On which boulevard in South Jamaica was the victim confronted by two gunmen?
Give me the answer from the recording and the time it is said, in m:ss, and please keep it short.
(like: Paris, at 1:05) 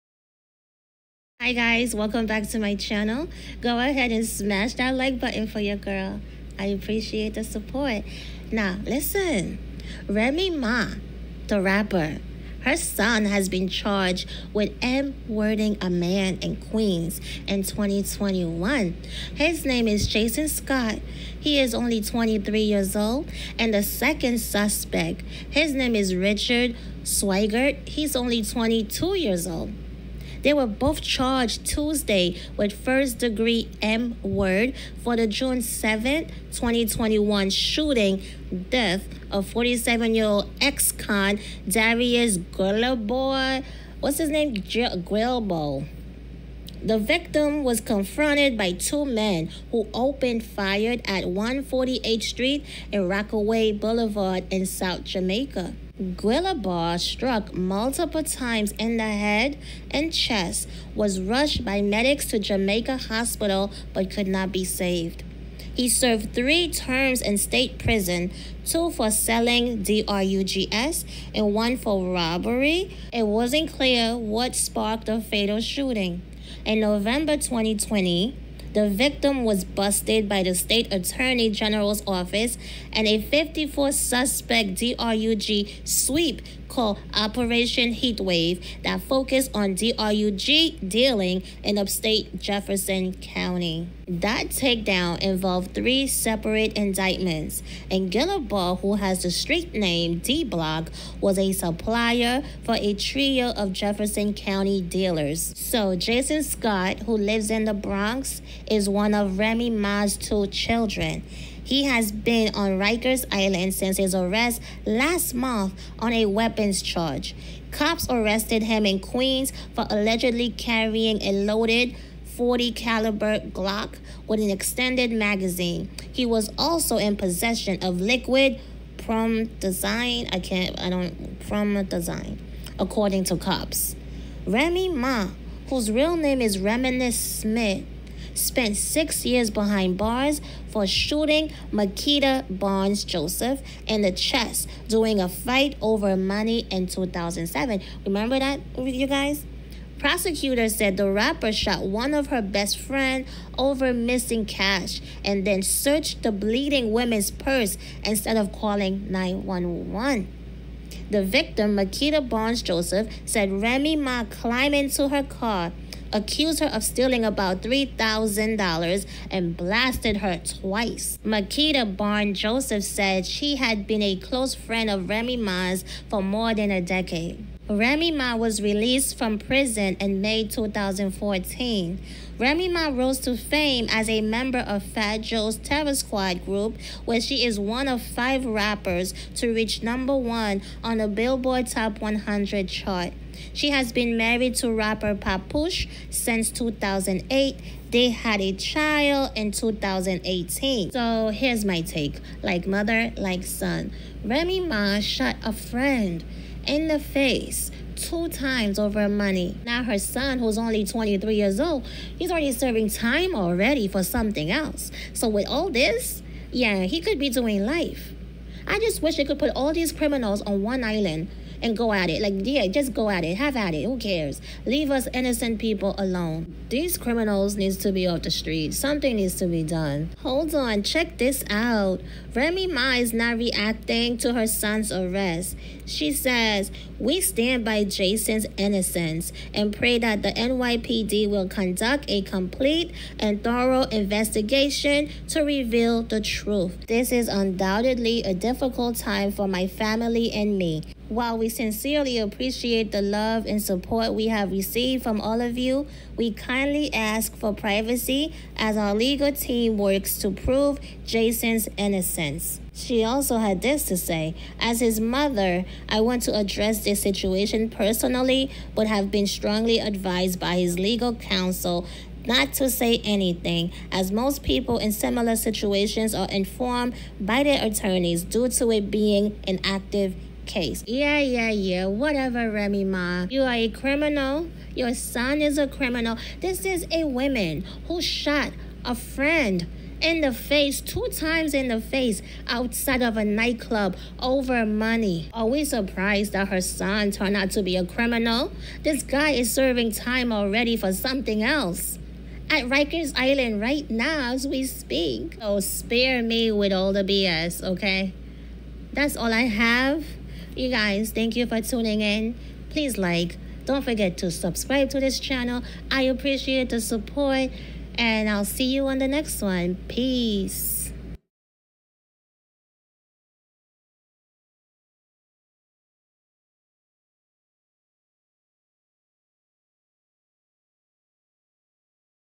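Rockaway Boulevard, at 0:53.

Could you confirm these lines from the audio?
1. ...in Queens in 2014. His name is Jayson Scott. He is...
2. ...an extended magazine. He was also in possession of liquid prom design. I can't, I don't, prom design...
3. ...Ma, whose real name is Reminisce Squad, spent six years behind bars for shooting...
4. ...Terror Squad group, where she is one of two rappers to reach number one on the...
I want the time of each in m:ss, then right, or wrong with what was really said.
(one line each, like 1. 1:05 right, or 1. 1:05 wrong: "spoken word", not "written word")
1. 0:16 wrong: "2021", not "2014"
2. 2:04 right
3. 2:14 wrong: "Smith", not "Squad"
4. 3:05 wrong: "five", not "two".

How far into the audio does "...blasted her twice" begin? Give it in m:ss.
2:49.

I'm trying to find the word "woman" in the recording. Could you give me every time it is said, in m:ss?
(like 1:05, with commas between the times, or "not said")
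2:36, 4:47.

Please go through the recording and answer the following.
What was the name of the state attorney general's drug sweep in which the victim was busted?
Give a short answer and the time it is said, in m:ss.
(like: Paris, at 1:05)
Operation Heatwave, at 1:27.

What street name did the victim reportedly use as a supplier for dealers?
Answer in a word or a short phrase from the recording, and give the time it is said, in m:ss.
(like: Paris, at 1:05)
D Block, at 1:40.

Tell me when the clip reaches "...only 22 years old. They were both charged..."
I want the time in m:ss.
0:28.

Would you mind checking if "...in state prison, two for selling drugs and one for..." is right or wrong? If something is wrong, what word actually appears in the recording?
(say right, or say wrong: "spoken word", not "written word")
right.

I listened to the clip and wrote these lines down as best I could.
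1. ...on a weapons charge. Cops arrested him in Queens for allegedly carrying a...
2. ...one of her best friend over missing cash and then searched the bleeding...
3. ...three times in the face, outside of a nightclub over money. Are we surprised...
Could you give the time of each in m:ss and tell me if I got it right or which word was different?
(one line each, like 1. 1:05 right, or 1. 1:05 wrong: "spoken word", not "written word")
1. 1:55 right
2. 2:31 right
3. 4:50 wrong: "two", not "three".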